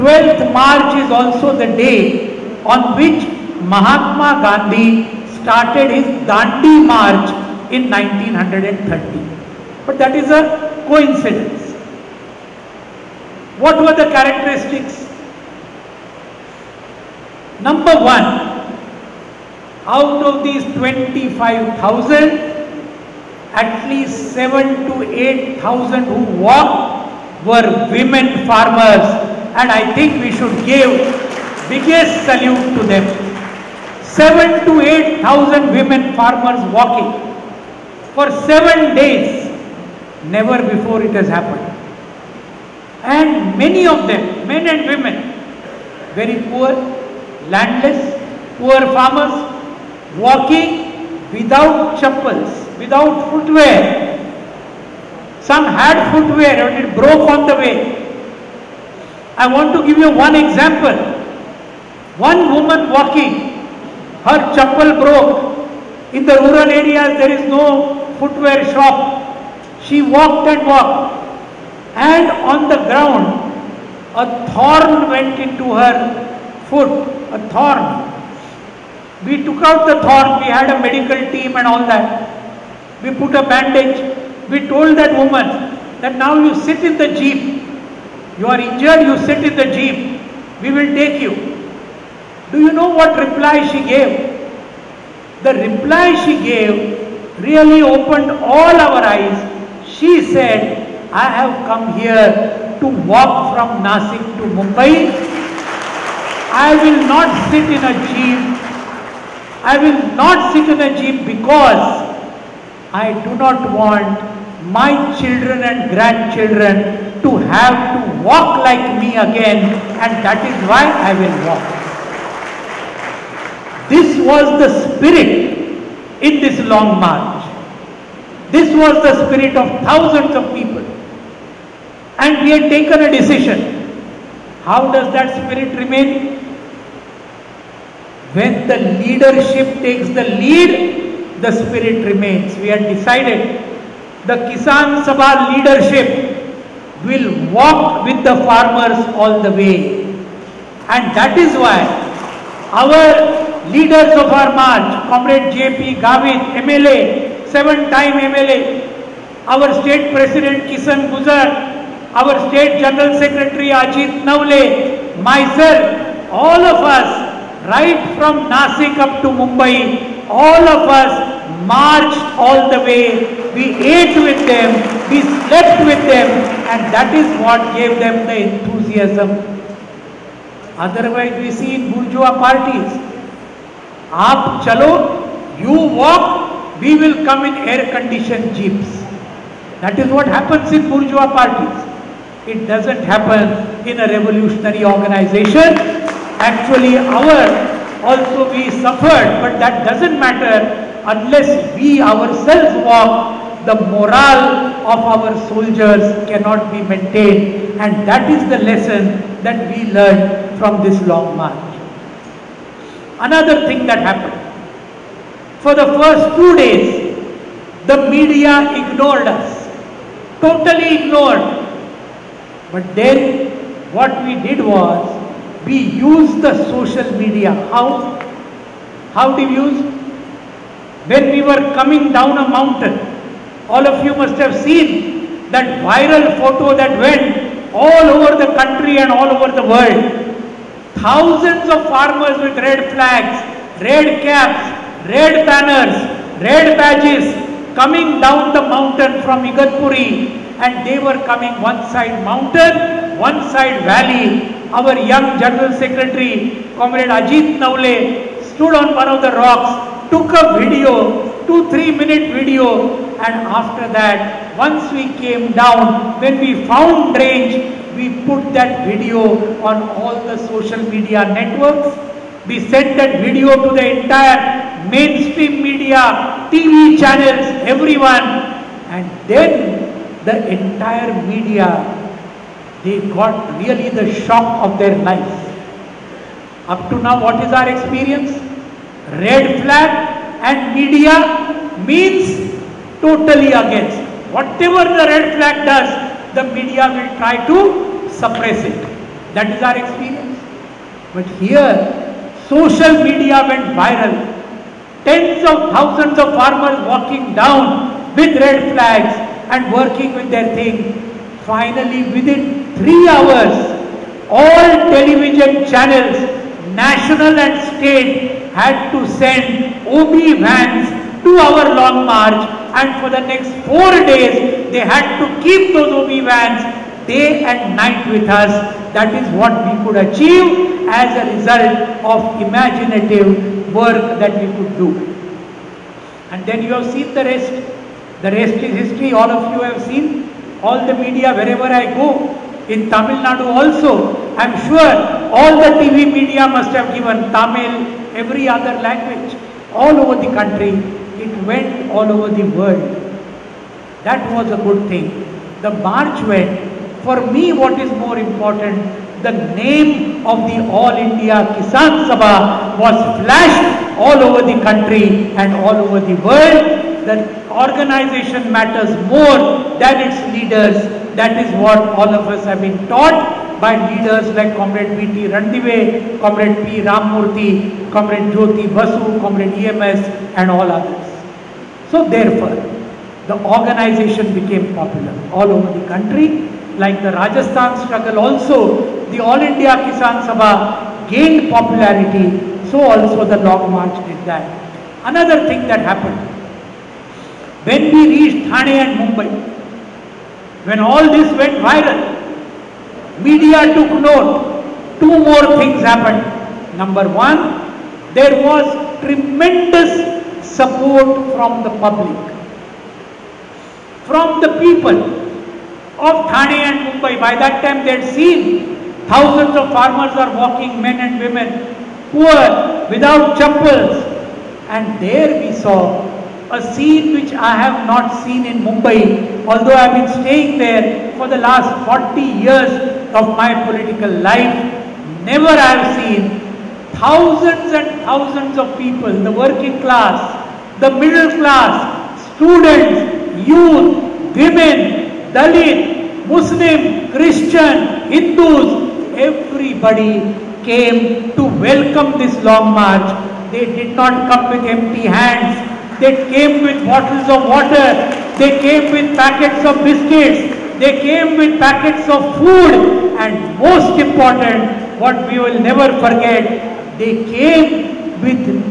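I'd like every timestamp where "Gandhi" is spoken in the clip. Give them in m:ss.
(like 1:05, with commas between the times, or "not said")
0:04.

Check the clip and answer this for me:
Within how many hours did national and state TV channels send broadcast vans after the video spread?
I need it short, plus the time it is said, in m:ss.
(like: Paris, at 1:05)
three hours, at 5:12.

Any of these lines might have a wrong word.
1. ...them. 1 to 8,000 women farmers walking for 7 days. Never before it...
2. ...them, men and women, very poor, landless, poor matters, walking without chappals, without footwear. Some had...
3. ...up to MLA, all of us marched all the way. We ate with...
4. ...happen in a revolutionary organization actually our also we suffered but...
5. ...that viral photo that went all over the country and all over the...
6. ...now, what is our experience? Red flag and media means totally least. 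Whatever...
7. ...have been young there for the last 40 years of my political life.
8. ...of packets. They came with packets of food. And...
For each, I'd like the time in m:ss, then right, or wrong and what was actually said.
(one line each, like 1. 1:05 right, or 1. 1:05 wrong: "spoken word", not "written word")
1. 0:32 wrong: "7", not "1"
2. 0:44 wrong: "farmers", not "matters"
3. 2:48 wrong: "Mumbai", not "MLA"
4. 3:13 right
5. 3:55 right
6. 4:46 wrong: "against", not "least"
7. 7:09 wrong: "staying", not "young"
8. 7:39 wrong: "biscuits", not "packets".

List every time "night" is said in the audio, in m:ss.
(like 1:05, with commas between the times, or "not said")
5:27.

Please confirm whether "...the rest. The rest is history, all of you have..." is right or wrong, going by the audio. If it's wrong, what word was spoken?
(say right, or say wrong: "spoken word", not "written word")
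right.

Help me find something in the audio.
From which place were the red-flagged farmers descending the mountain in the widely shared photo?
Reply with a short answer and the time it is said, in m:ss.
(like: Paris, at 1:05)
Igatpuri, at 4:09.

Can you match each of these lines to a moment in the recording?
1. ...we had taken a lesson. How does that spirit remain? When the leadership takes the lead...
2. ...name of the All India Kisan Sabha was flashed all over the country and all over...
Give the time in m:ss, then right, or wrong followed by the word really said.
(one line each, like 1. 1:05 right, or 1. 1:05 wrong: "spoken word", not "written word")
1. 2:12 wrong: "decision", not "lesson"
2. 5:59 right.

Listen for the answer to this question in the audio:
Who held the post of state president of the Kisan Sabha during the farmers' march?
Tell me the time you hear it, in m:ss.
2:40.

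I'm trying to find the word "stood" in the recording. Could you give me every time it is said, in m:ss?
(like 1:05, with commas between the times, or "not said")
4:18.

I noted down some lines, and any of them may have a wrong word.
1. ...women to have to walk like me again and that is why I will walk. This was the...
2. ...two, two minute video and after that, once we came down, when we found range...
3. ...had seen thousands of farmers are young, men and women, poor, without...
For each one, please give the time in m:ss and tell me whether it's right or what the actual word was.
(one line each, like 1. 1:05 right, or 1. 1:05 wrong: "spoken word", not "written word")
1. 1:55 wrong: "grandchildren", not "women"
2. 4:21 wrong: "three", not "two"
3. 6:57 wrong: "walking", not "young".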